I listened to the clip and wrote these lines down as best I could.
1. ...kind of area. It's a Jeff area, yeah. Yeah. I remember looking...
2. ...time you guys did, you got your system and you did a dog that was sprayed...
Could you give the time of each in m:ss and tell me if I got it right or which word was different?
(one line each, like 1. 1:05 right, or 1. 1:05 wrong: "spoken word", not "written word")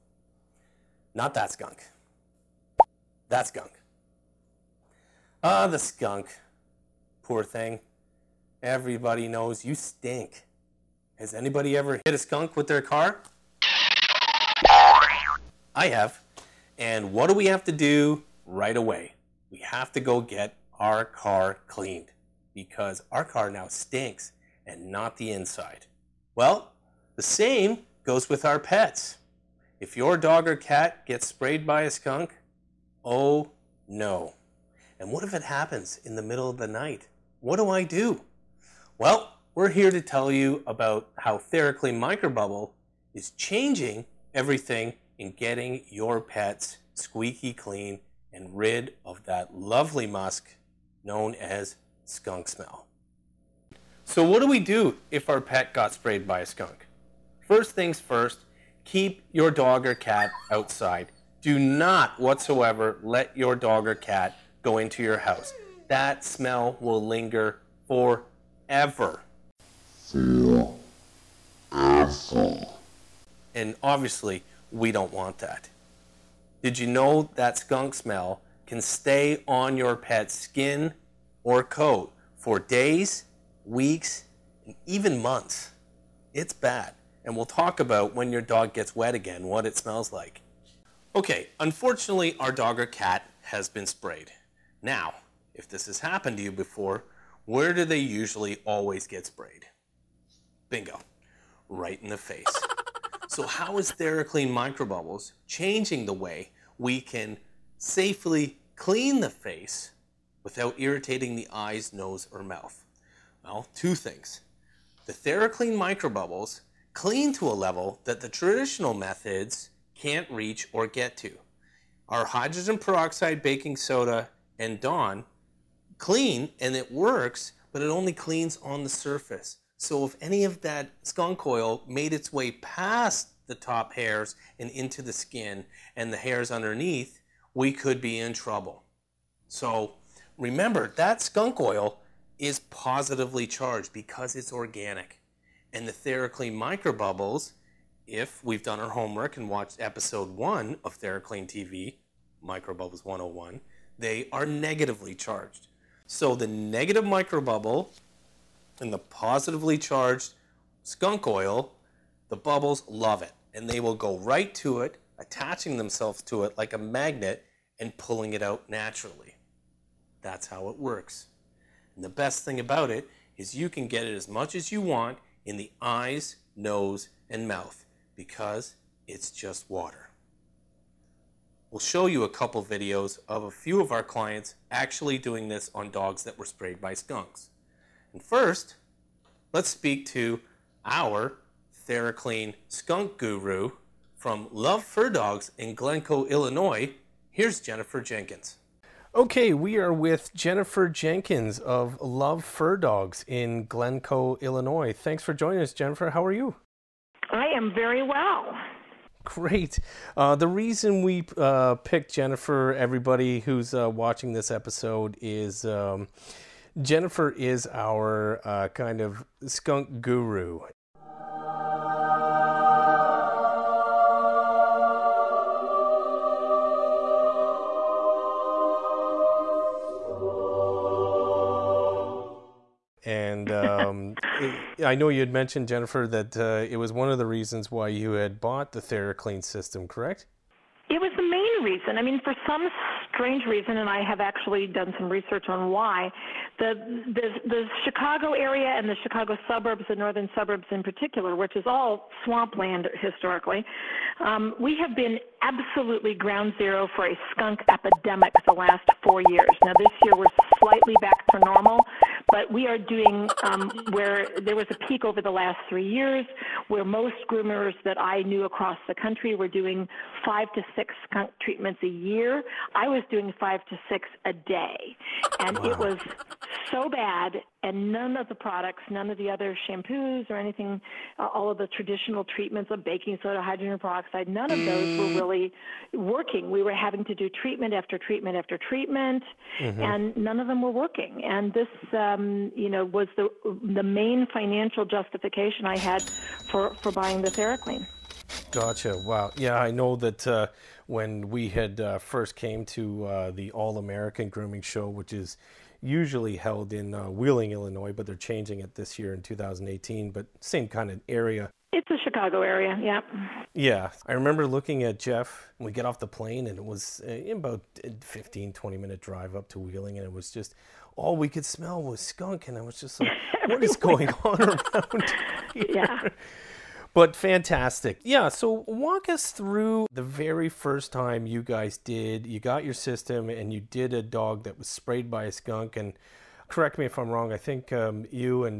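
1. 5:10 wrong: "Chicago", not "Jeff"
2. 5:30 right.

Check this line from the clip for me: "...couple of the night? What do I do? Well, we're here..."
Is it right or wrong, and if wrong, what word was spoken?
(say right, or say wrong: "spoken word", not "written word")
wrong: "middle", not "couple".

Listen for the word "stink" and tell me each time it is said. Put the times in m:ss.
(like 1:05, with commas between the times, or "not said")
0:09, 0:23.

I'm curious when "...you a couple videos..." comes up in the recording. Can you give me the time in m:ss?
3:02.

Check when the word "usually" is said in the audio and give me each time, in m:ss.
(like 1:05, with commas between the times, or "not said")
1:37, 5:05.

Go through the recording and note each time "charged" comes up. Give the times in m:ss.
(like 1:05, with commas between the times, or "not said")
2:23, 2:35, 2:39.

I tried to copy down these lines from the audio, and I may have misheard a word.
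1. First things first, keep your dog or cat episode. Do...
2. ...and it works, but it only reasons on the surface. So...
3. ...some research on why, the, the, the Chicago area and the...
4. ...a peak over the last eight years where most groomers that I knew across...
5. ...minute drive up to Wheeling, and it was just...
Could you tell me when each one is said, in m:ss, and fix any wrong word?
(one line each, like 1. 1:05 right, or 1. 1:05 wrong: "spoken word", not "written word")
1. 0:57 wrong: "outside", not "episode"
2. 2:06 wrong: "cleans", not "reasons"
3. 4:04 right
4. 4:24 wrong: "three", not "eight"
5. 5:18 right.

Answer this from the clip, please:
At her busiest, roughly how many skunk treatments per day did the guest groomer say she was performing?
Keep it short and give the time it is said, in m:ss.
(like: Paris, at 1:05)
5 to 6, at 4:33.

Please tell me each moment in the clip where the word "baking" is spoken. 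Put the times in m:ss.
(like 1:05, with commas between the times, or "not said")
2:03, 4:42.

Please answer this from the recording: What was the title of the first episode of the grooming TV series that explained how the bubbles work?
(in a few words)
Microbubbles 101.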